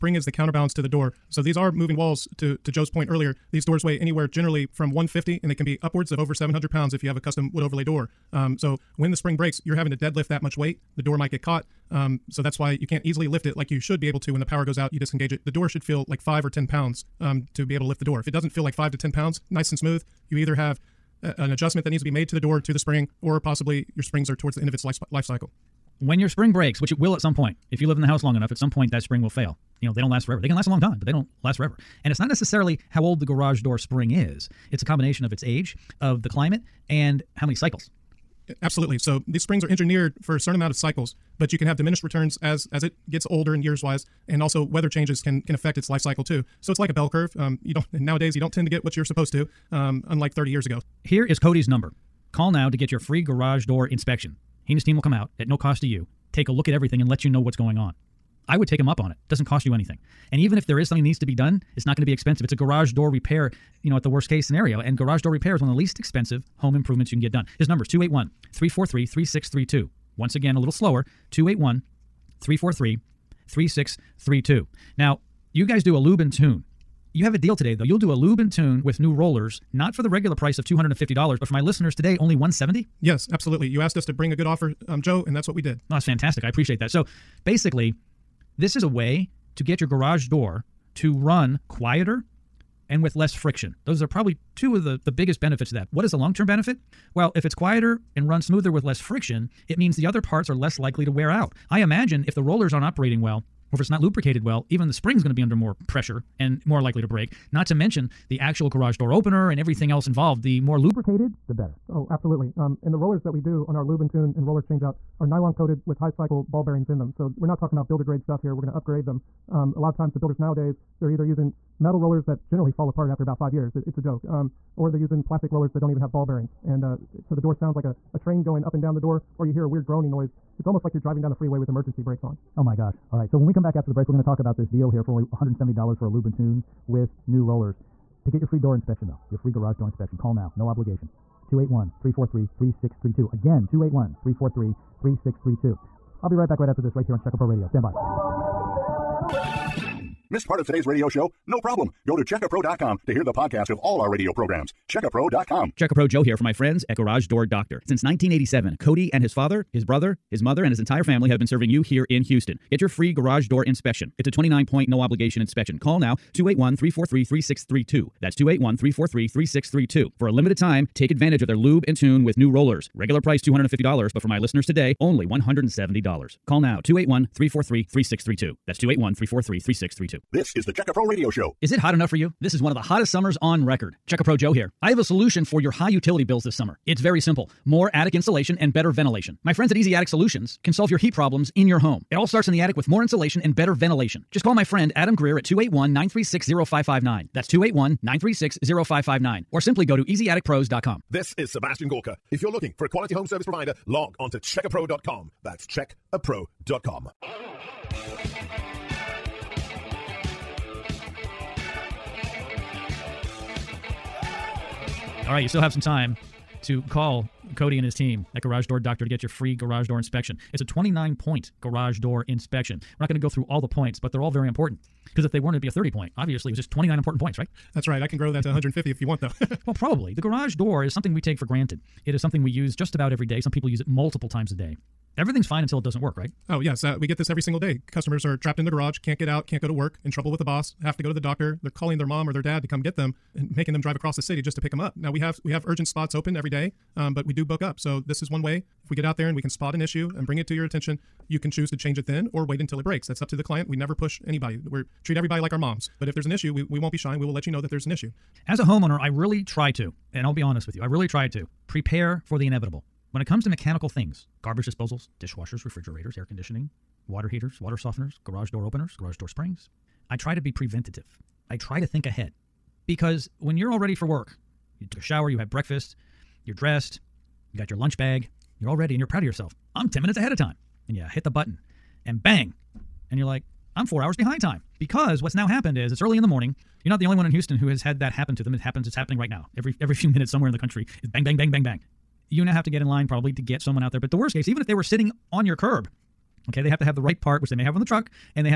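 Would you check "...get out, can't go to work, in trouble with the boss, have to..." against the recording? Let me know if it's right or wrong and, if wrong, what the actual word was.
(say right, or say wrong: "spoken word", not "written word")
right.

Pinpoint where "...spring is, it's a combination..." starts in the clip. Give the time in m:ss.
0:33.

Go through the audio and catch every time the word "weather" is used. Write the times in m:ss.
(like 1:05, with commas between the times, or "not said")
0:44.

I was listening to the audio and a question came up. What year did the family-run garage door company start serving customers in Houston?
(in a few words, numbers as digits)
1987.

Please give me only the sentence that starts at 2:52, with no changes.
Regular price $250, but for my listeners today, only $170.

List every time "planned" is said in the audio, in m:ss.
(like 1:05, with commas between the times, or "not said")
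not said.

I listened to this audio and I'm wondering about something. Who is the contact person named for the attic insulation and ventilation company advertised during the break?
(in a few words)
Adam Greer.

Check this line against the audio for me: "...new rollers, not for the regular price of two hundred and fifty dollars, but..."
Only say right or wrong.
right.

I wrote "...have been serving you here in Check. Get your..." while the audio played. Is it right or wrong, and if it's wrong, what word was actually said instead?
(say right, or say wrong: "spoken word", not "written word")
wrong: "Houston", not "Check".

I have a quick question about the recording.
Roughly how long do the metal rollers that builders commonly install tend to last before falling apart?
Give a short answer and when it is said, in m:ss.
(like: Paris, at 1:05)
5 years, at 2:03.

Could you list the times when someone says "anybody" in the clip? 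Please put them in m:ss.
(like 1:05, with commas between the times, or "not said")
4:14.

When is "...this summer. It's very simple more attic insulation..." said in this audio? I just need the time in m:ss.
3:06.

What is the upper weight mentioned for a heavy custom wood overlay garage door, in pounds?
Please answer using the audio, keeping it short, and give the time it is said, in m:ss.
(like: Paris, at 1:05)
700, at 0:06.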